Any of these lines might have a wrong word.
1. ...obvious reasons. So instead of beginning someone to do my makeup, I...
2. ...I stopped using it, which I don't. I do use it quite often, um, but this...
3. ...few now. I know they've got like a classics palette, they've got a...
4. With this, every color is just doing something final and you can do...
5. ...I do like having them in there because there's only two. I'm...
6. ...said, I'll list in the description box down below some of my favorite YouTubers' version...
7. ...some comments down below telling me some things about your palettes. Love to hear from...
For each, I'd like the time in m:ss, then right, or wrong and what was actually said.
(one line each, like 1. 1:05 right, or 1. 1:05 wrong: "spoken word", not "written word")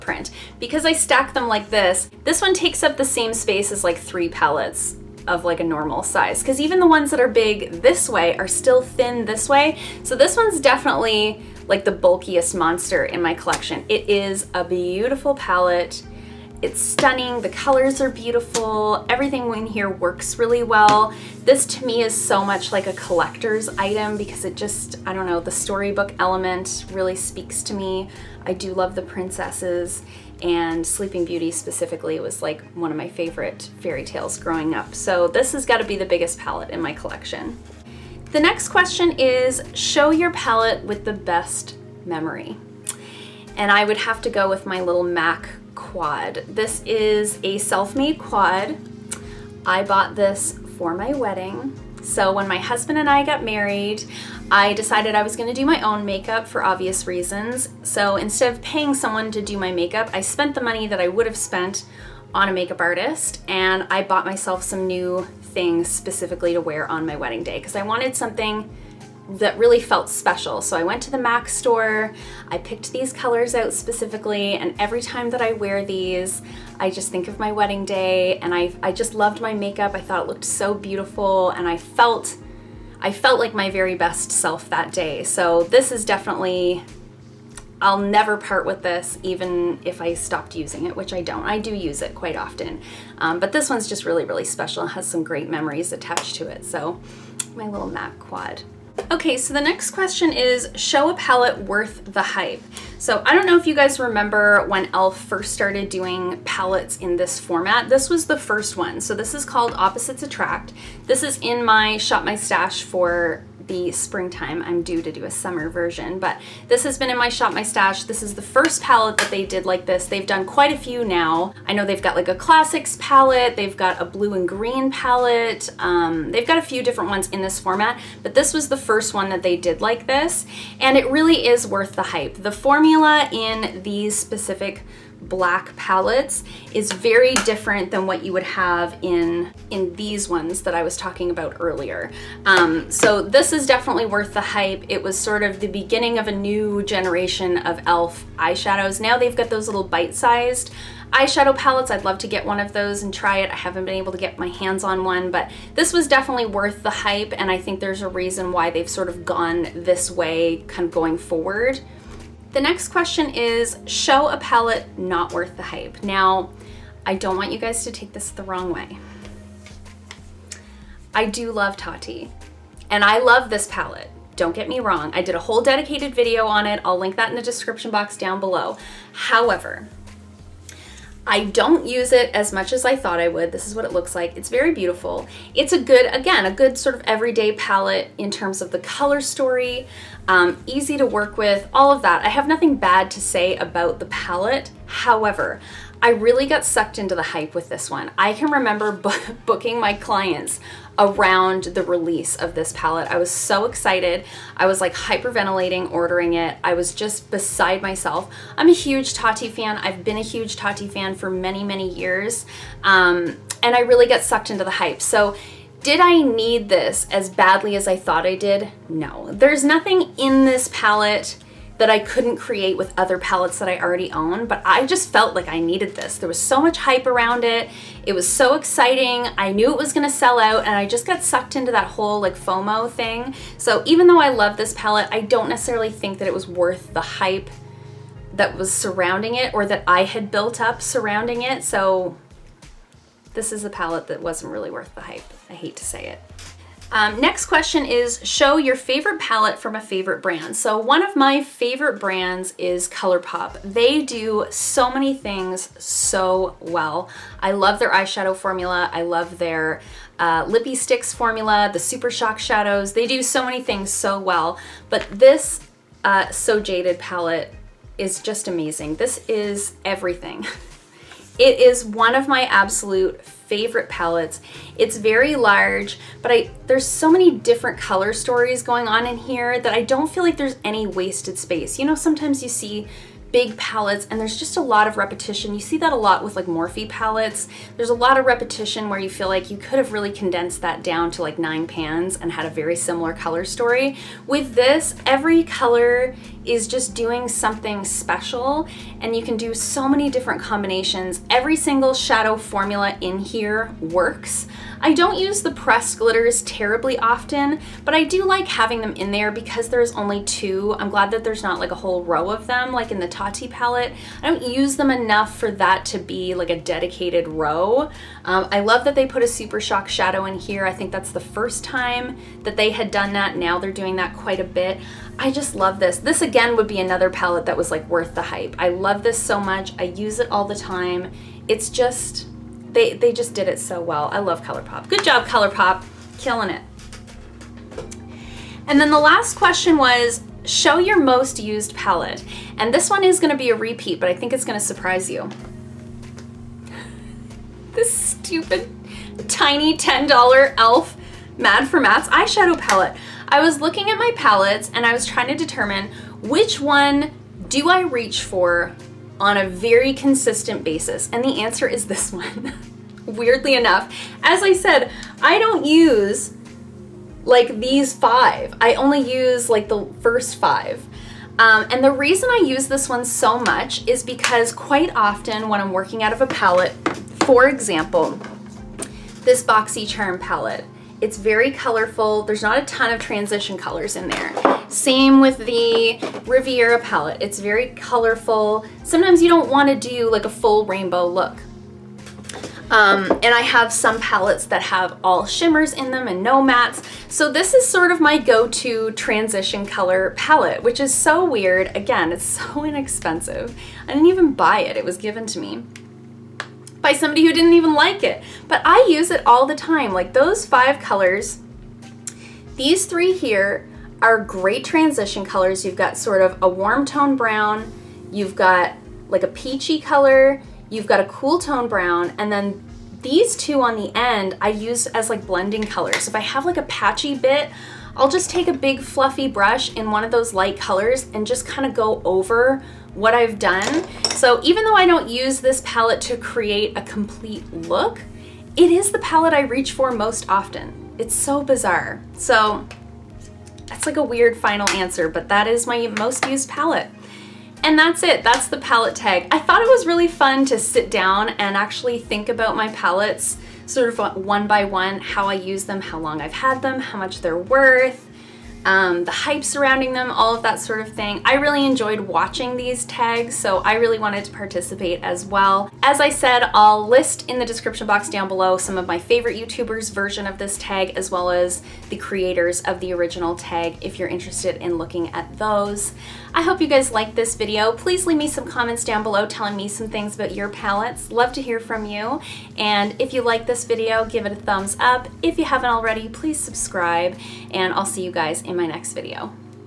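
1. 0:56 wrong: "paying", not "beginning"
2. 1:30 right
3. 2:00 right
4. 4:54 wrong: "special", not "final"
5. 5:07 right
6. 7:46 right
7. 7:58 right.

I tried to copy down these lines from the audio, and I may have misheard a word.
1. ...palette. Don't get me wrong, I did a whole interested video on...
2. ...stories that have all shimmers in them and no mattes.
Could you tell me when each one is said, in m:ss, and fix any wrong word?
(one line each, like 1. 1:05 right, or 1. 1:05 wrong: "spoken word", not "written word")
1. 2:53 wrong: "dedicated", not "interested"
2. 6:34 wrong: "palettes", not "stories".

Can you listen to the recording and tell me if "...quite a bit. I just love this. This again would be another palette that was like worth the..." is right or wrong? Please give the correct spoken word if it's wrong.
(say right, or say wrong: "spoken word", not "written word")
right.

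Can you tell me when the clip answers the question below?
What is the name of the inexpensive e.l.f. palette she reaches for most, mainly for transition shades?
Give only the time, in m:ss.
5:51.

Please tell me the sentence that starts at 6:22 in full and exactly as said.
There's not a ton of transition colors in there.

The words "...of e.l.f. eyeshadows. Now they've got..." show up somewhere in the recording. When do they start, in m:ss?
2:27.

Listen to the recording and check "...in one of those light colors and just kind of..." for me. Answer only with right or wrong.
right.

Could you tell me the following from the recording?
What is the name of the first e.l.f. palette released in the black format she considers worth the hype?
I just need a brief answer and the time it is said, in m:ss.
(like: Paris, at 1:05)
Opposites Attract, at 1:49.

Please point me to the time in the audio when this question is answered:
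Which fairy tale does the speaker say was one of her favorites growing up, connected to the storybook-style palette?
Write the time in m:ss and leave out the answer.
0:30.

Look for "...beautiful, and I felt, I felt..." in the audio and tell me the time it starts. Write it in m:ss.
1:20.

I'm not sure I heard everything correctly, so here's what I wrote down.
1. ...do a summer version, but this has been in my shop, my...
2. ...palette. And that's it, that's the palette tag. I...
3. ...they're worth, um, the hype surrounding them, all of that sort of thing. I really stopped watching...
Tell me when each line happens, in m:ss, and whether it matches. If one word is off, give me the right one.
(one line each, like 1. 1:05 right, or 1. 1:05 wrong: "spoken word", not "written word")
1. 1:55 right
2. 7:26 right
3. 7:37 wrong: "enjoyed", not "stopped".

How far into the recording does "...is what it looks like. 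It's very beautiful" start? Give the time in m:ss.
3:03.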